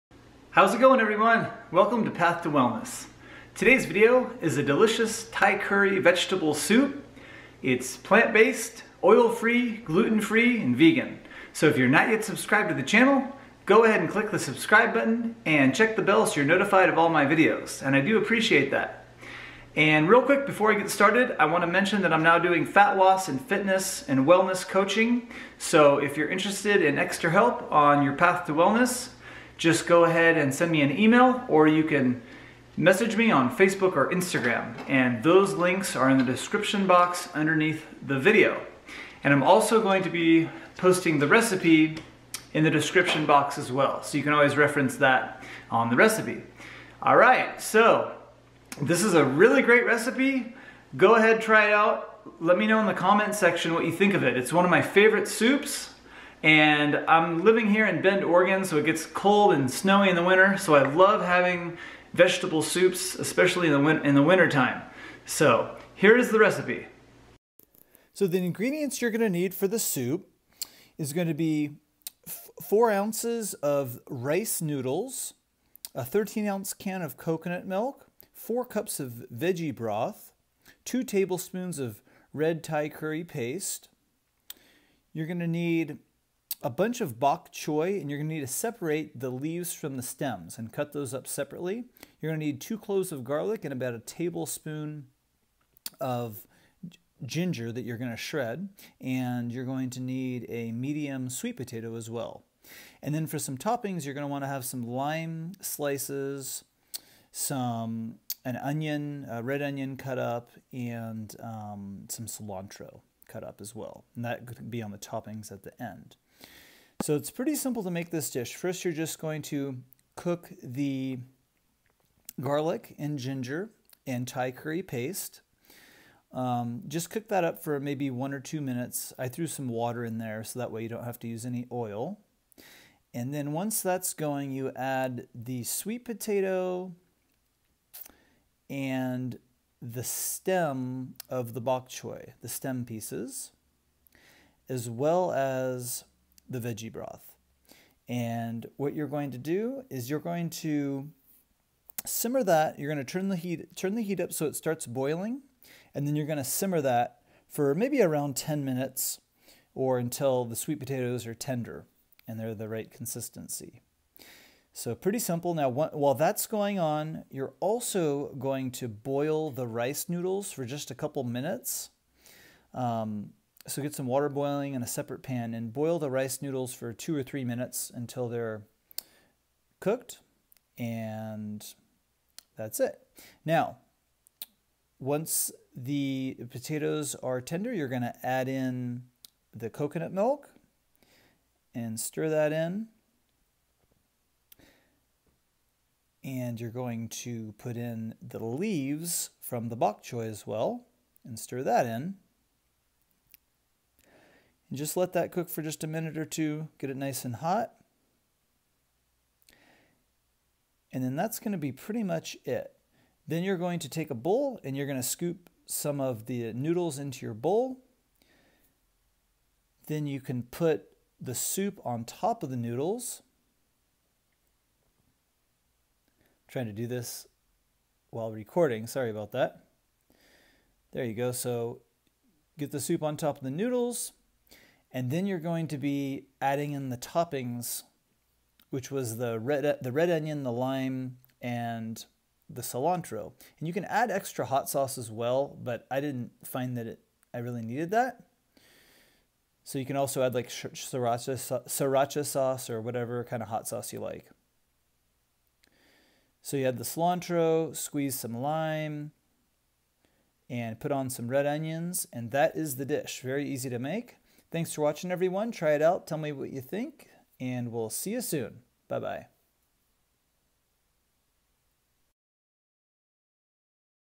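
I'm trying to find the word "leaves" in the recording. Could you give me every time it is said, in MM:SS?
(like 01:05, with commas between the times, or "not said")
01:29, 03:18.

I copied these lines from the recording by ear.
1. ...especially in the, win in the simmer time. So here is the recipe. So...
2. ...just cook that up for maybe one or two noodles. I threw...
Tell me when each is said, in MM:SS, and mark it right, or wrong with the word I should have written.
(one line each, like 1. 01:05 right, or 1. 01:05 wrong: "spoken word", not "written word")
1. 01:03 wrong: "winter", not "simmer"
2. 02:06 wrong: "minutes", not "noodles".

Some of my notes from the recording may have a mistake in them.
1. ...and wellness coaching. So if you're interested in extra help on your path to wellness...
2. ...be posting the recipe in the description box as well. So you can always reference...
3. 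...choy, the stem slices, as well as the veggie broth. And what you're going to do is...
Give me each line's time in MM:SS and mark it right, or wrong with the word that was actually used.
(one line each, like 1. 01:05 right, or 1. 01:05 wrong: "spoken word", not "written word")
1. 00:24 right
2. 00:40 right
3. 02:21 wrong: "pieces", not "slices".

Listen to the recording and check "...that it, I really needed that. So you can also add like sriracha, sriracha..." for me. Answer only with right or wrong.
right.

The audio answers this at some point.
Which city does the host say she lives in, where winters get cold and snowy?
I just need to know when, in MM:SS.
00:58.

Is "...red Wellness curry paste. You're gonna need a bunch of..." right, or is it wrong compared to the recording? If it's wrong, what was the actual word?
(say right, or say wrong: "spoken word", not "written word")
wrong: "Thai", not "Wellness".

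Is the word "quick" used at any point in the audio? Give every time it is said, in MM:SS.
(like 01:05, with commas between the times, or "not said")
00:20.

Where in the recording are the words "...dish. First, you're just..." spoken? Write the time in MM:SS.
01:58.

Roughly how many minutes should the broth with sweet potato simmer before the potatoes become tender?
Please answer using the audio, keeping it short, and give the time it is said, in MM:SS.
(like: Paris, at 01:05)
10, at 02:38.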